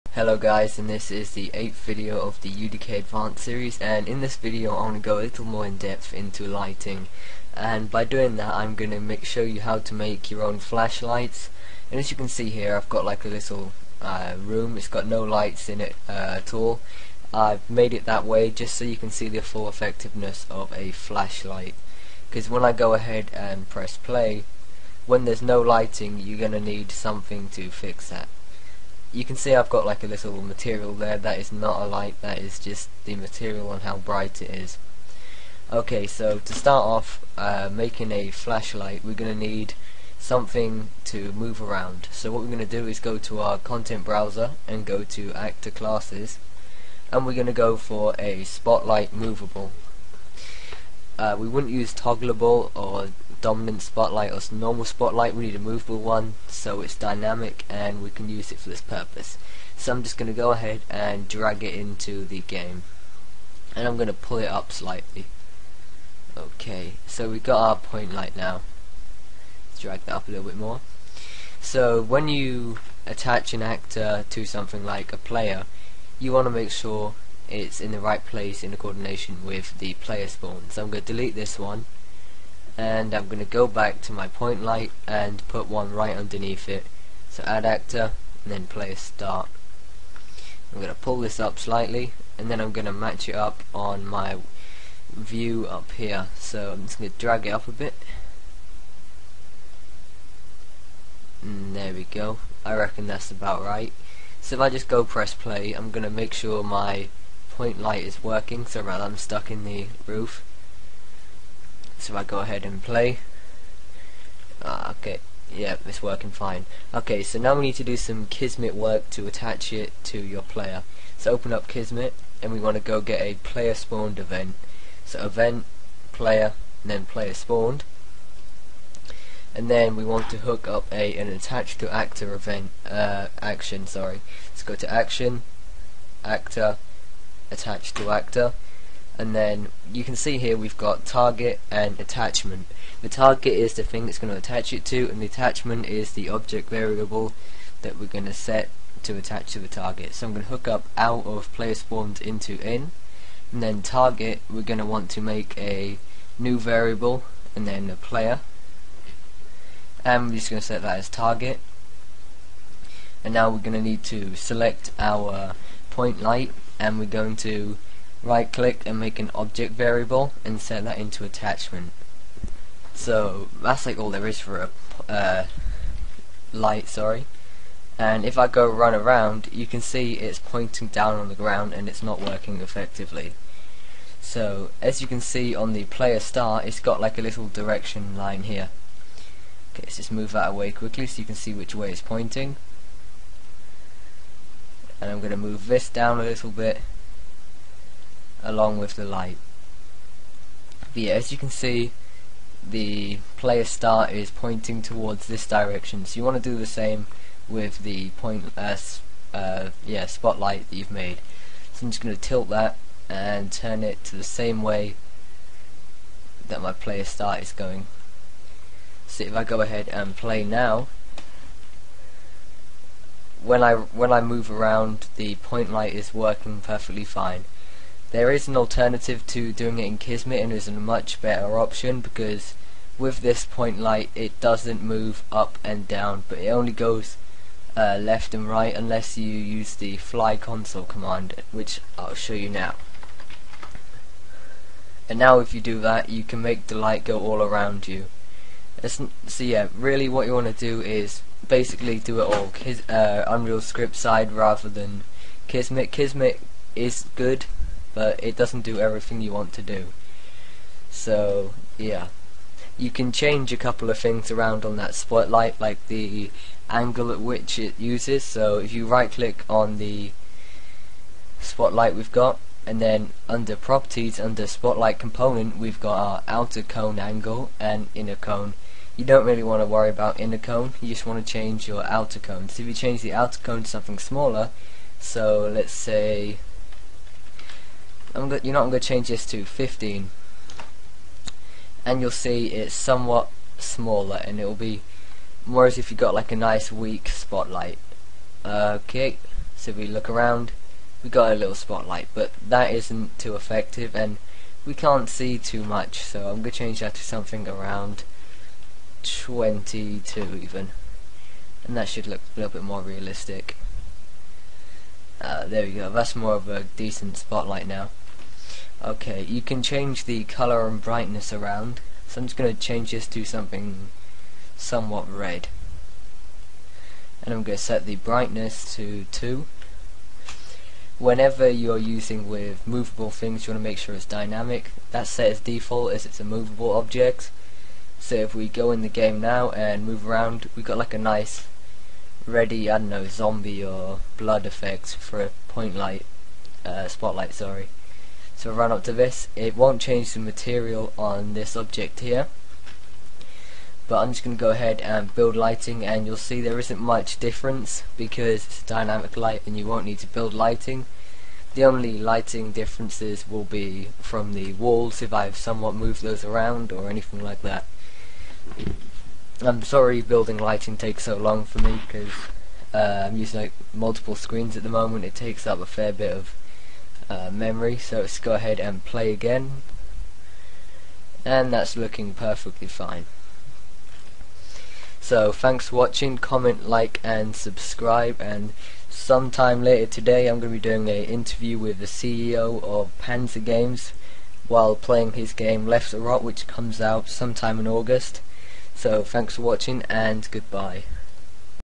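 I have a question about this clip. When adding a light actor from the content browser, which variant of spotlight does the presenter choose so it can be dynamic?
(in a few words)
spotlight movable.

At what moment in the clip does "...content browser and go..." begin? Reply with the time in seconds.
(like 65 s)
43 s.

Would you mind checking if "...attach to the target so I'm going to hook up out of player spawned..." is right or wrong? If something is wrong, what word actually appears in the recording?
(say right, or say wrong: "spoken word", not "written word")
right.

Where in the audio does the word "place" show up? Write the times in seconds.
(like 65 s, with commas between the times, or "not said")
78 s.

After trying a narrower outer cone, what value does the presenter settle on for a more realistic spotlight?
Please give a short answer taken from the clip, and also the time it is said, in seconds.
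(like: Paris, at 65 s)
22, at 309 s.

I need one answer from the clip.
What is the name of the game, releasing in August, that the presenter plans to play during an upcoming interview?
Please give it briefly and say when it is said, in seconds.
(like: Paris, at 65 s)
Left the Rot, at 395 s.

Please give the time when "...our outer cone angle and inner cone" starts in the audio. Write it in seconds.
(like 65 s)
275 s.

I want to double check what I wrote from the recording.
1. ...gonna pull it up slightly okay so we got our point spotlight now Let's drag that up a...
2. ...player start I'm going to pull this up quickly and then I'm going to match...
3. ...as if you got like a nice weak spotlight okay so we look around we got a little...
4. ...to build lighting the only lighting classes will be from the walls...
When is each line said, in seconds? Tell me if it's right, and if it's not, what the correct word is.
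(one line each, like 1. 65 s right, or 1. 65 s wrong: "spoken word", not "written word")
1. 63 s wrong: "light", not "spotlight"
2. 88 s wrong: "slightly", not "quickly"
3. 295 s right
4. 359 s wrong: "differences", not "classes".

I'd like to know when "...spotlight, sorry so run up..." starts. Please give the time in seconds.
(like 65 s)
346 s.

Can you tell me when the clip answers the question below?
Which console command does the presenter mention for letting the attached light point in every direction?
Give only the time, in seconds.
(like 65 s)
239 s.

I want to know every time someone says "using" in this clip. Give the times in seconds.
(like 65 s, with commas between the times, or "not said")
331 s, 373 s.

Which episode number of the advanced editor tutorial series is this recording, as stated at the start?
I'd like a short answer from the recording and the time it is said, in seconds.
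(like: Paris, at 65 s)
8th, at 1 s.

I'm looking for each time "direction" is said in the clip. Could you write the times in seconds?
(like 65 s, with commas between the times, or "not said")
187 s, 205 s.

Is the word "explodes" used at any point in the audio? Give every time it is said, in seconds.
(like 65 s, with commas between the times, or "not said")
not said.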